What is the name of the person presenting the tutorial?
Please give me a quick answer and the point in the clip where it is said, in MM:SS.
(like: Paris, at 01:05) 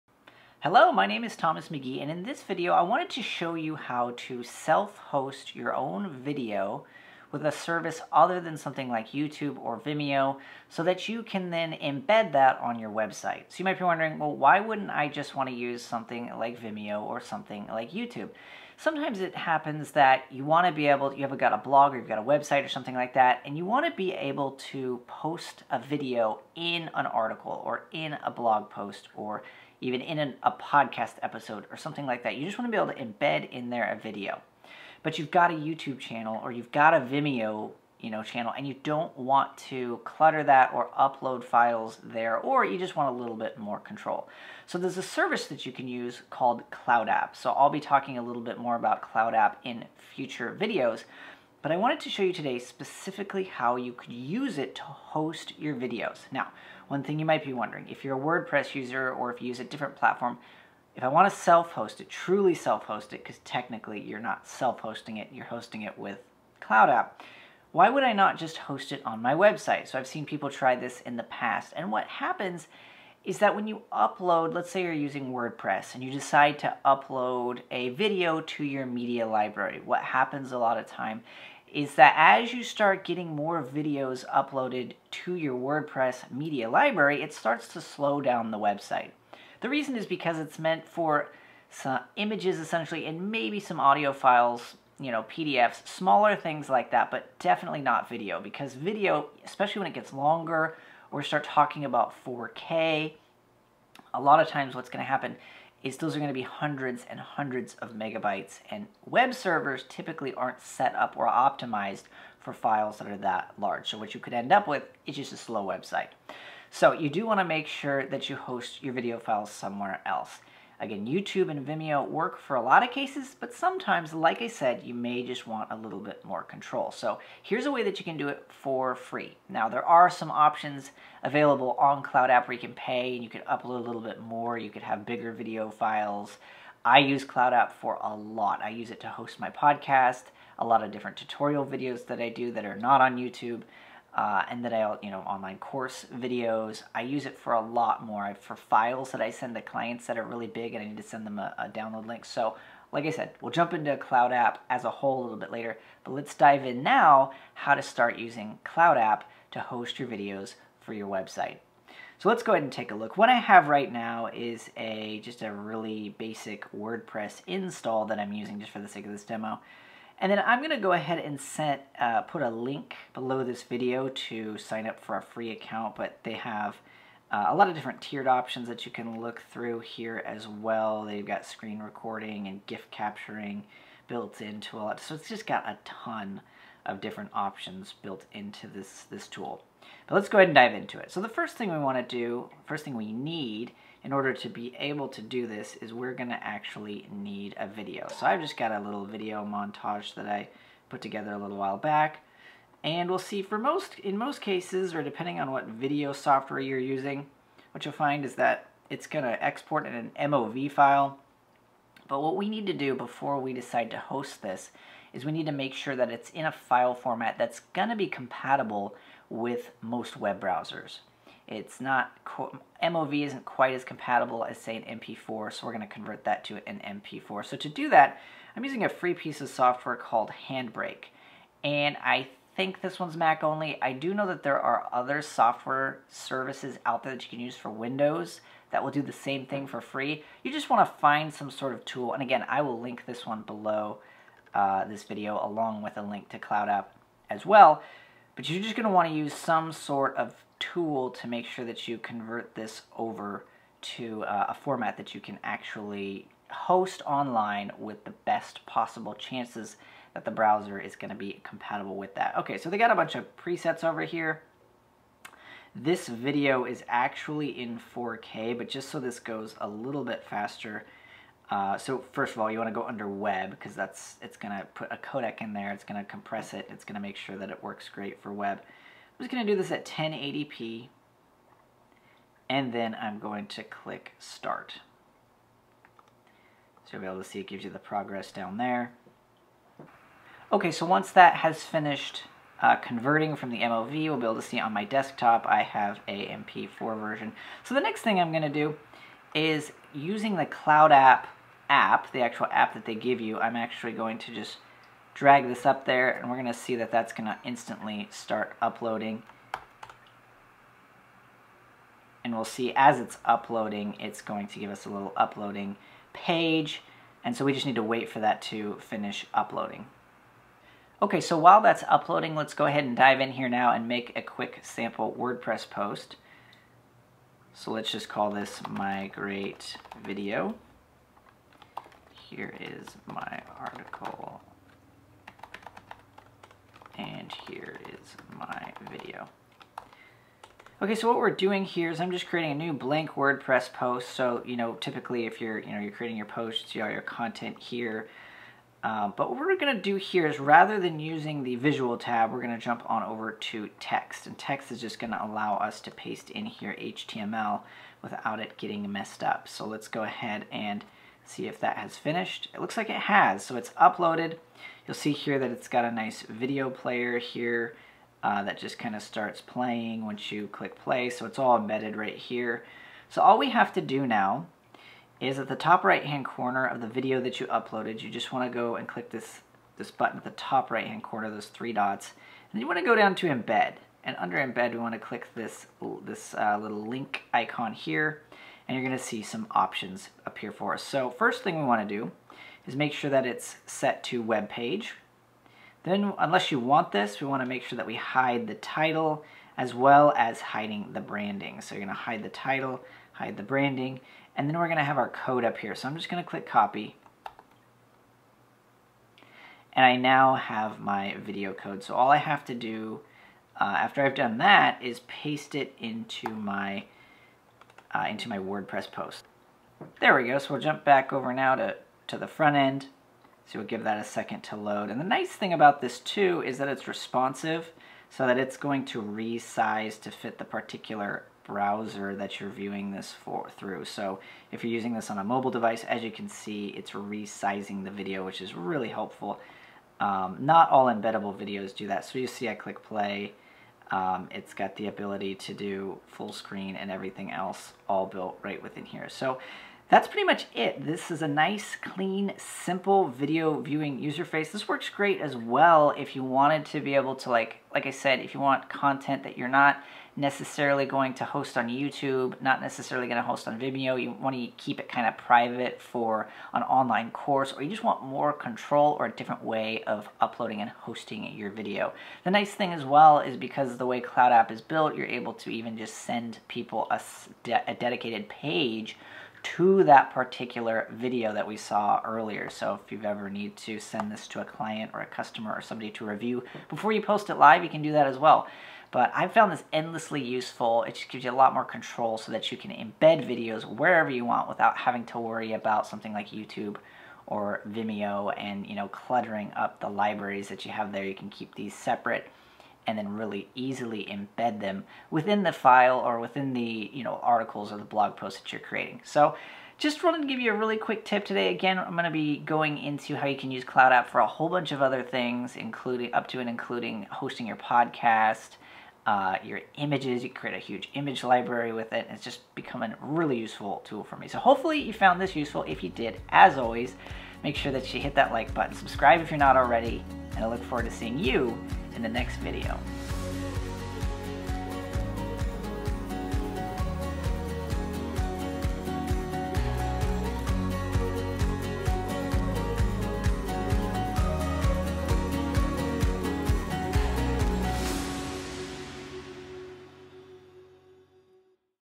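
Thomas McGee, at 00:01.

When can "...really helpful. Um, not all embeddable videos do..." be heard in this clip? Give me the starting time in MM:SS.
07:18.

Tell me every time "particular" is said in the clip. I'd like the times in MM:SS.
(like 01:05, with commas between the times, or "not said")
07:10, 08:00.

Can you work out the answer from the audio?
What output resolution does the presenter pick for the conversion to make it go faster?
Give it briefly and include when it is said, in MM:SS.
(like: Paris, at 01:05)
1080p, at 04:39.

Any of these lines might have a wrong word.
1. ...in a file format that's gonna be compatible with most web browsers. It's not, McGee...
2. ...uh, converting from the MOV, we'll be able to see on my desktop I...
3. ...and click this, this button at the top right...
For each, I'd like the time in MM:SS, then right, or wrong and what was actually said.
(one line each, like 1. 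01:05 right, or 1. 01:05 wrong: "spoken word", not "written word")
1. 03:36 wrong: "MOV", not "McGee"
2. 04:52 right
3. 06:18 right.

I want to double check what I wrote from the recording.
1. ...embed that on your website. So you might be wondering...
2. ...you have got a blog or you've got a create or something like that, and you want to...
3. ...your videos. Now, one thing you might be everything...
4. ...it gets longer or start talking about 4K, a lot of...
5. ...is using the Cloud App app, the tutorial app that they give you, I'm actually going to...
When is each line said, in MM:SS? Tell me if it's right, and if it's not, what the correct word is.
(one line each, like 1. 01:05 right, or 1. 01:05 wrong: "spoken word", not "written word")
1. 00:11 right
2. 00:21 wrong: "website", not "create"
3. 00:55 wrong: "wondering", not "everything"
4. 01:39 right
5. 04:59 wrong: "actual", not "tutorial".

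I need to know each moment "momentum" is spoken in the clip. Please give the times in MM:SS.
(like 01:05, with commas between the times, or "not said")
not said.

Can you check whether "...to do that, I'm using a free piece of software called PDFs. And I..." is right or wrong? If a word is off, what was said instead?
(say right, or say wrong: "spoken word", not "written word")
wrong: "Handbrake", not "PDFs".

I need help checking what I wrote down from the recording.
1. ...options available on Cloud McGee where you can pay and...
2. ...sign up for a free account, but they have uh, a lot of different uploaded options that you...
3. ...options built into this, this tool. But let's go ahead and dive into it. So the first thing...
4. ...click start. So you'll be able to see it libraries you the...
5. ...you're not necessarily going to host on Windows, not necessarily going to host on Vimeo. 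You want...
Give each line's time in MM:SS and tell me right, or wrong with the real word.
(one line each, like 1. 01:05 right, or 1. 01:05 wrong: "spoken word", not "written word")
1. 02:10 wrong: "App", not "McGee"
2. 02:54 wrong: "tiered", not "uploaded"
3. 03:07 right
4. 04:43 wrong: "gives", not "libraries"
5. 07:39 wrong: "YouTube", not "Windows".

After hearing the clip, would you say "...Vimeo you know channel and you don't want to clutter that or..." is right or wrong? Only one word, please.
right.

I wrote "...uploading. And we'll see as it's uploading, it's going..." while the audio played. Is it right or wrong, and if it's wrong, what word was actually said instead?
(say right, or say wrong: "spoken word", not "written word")
right.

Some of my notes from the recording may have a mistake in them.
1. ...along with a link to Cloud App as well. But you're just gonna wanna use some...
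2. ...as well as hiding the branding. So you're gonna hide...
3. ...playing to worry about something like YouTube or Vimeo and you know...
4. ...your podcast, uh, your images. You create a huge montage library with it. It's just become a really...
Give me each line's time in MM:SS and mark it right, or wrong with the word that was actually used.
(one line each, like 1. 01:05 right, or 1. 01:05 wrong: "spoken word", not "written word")
1. 04:05 right
2. 06:39 right
3. 08:14 wrong: "having", not "playing"
4. 08:37 wrong: "image", not "montage".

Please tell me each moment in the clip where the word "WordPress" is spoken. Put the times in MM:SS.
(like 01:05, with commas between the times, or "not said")
00:58, 01:15, 01:25, 02:46, 05:25, 05:43, 06:58.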